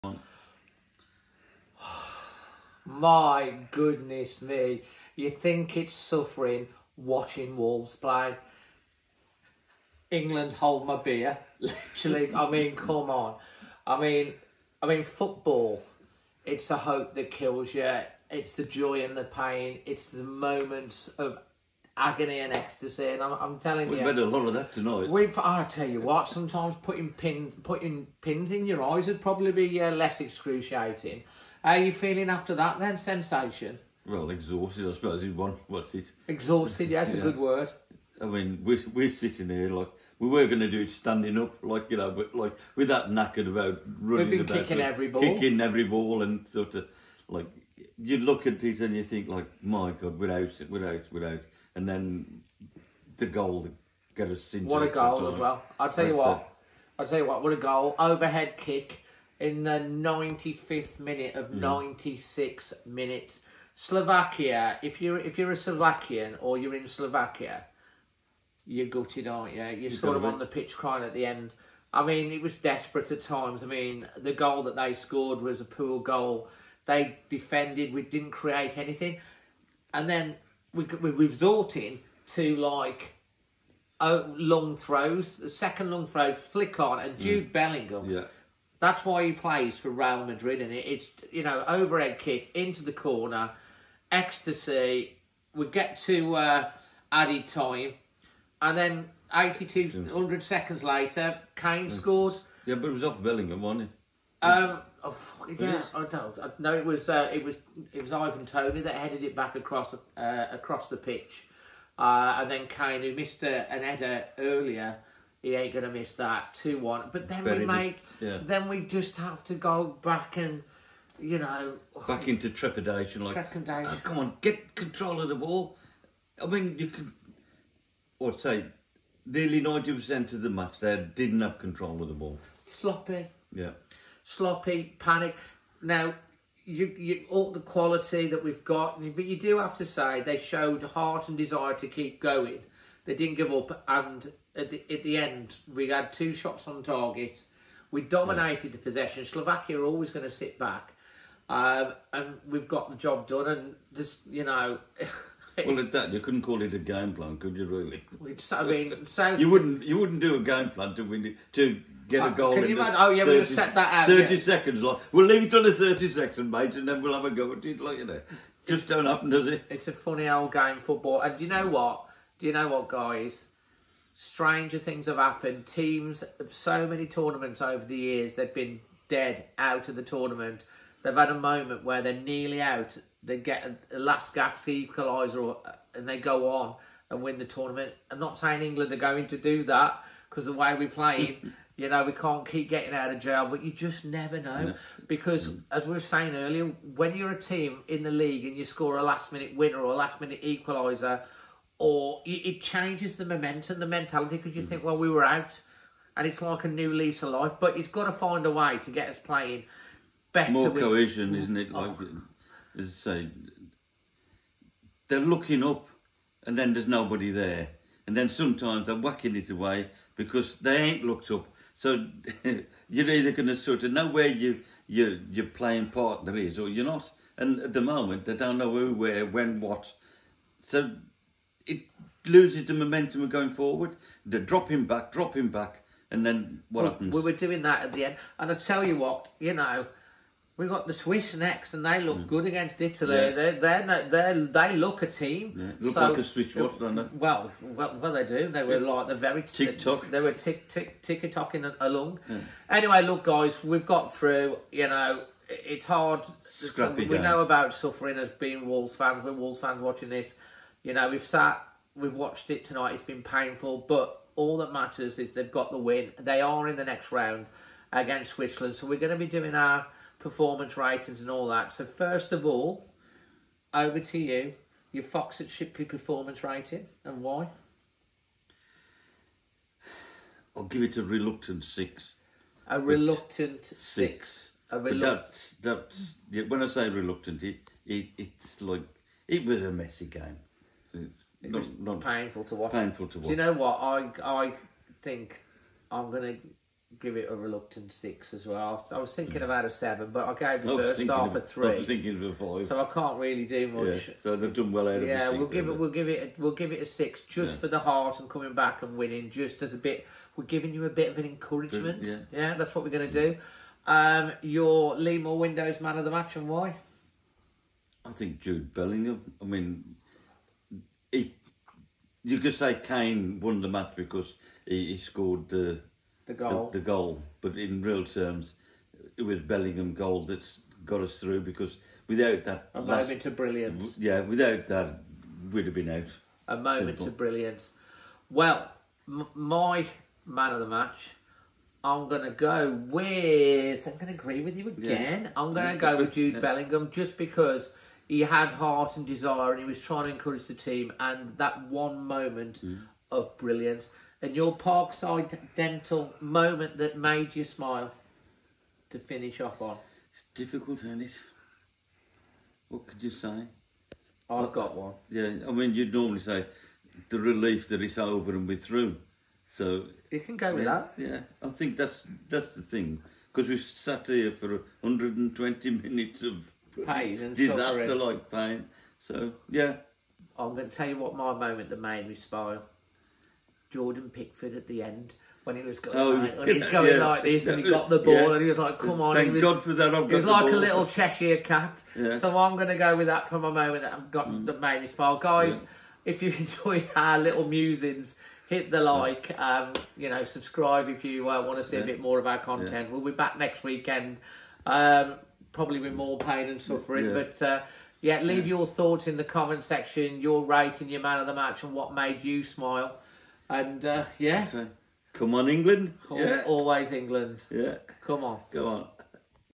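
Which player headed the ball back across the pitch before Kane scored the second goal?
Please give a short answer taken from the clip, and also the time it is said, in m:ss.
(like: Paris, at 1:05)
Ivan Toney, at 1:48.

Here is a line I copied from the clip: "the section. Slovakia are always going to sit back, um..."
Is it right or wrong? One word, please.
wrong.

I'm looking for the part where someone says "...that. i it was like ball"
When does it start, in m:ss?
6:29.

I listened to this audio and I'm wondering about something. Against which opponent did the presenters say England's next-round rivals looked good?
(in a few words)
Italy.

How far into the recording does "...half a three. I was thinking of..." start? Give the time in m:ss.
5:01.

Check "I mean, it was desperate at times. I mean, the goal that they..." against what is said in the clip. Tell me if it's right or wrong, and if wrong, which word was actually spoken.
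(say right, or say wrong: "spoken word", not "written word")
right.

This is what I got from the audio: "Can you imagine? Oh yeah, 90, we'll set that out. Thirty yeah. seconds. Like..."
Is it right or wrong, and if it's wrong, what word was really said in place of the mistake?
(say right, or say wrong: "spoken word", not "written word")
wrong: "30", not "90".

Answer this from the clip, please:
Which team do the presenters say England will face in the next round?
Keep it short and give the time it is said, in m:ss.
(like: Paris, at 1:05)
Switzerland, at 4:28.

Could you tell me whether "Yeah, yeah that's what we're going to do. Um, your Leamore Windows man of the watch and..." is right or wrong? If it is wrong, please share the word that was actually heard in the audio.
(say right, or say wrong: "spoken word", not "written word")
wrong: "match", not "watch".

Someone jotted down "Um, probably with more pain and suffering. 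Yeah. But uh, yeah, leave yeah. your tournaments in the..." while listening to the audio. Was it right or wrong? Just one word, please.
wrong.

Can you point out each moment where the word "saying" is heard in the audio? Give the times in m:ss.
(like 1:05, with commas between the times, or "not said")
3:08, 3:15.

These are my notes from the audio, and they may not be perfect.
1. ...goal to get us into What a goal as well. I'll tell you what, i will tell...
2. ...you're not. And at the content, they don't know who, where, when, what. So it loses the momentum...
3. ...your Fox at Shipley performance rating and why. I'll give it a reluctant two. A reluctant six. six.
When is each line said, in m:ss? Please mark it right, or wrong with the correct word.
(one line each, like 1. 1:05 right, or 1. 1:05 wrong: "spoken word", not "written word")
1. 0:53 right
2. 3:46 wrong: "moment", not "content"
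3. 4:34 wrong: "six", not "two".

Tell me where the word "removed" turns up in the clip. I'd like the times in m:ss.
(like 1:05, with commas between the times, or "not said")
not said.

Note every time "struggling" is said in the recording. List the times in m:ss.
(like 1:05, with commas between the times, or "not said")
not said.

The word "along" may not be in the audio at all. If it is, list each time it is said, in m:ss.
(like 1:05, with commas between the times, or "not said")
4:11.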